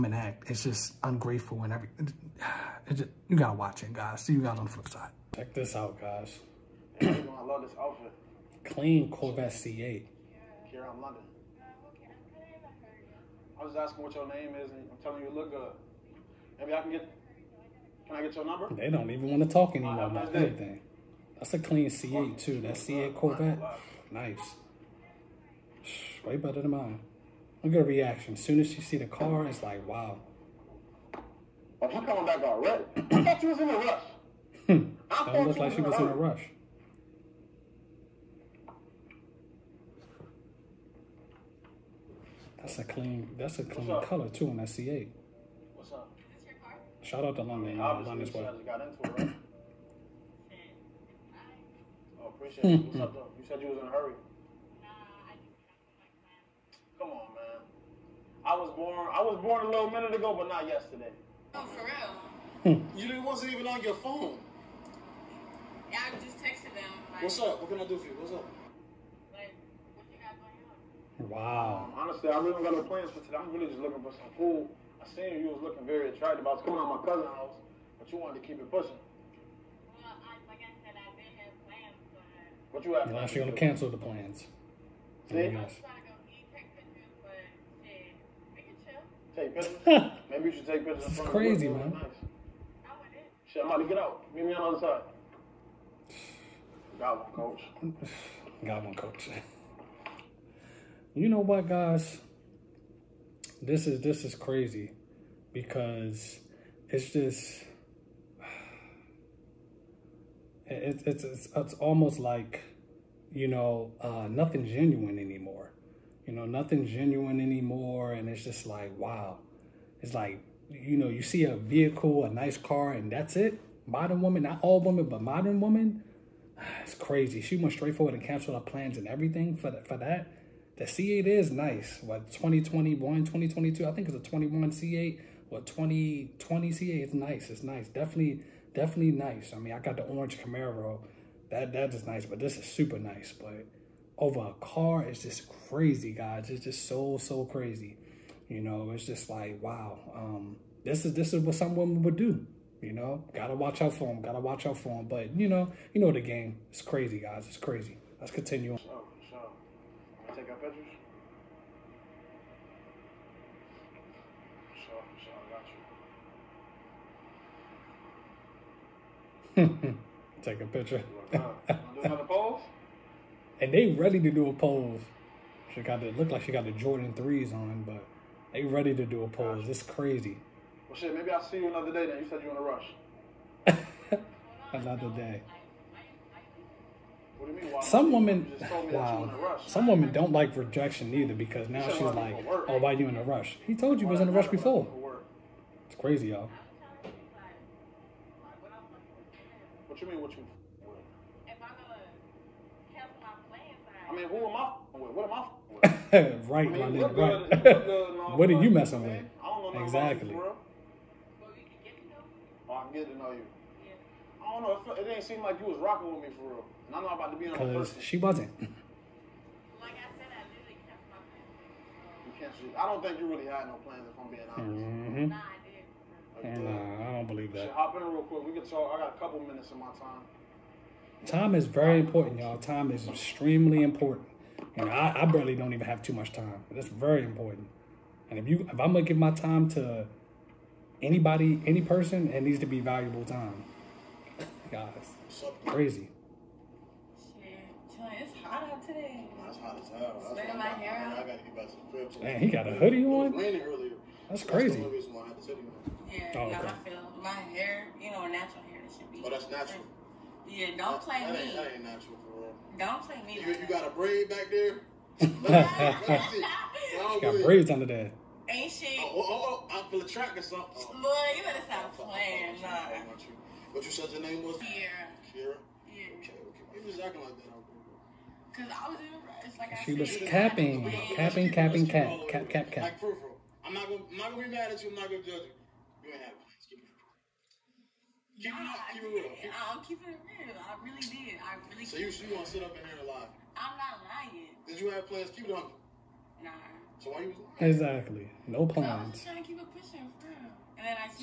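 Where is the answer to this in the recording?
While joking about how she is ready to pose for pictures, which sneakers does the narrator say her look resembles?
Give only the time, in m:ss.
2:56.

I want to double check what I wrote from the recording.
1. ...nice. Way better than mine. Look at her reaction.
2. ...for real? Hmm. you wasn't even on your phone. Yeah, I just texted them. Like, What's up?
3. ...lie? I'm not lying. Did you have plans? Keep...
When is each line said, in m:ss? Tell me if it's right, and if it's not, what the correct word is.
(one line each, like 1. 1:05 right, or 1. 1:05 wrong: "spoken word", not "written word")
1. 0:24 right
2. 1:01 right
3. 4:53 right.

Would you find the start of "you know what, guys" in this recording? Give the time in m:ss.
1:41.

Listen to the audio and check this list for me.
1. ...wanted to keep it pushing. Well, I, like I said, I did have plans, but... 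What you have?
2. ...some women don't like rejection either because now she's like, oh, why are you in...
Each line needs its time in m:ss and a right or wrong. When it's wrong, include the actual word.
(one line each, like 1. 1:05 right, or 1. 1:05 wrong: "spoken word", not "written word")
1. 1:18 right
2. 3:09 right.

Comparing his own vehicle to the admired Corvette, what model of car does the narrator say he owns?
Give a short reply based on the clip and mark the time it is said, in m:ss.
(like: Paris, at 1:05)
Camaro, at 2:20.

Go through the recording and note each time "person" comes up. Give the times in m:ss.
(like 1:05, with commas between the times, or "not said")
4:01.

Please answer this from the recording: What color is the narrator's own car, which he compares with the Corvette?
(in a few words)
Orange.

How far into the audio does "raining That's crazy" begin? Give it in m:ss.
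4:13.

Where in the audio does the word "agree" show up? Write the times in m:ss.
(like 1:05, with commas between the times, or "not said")
not said.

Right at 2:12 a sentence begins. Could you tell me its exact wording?
What, 2021, 2022, I think it's a 21 C8 or 2020 C8.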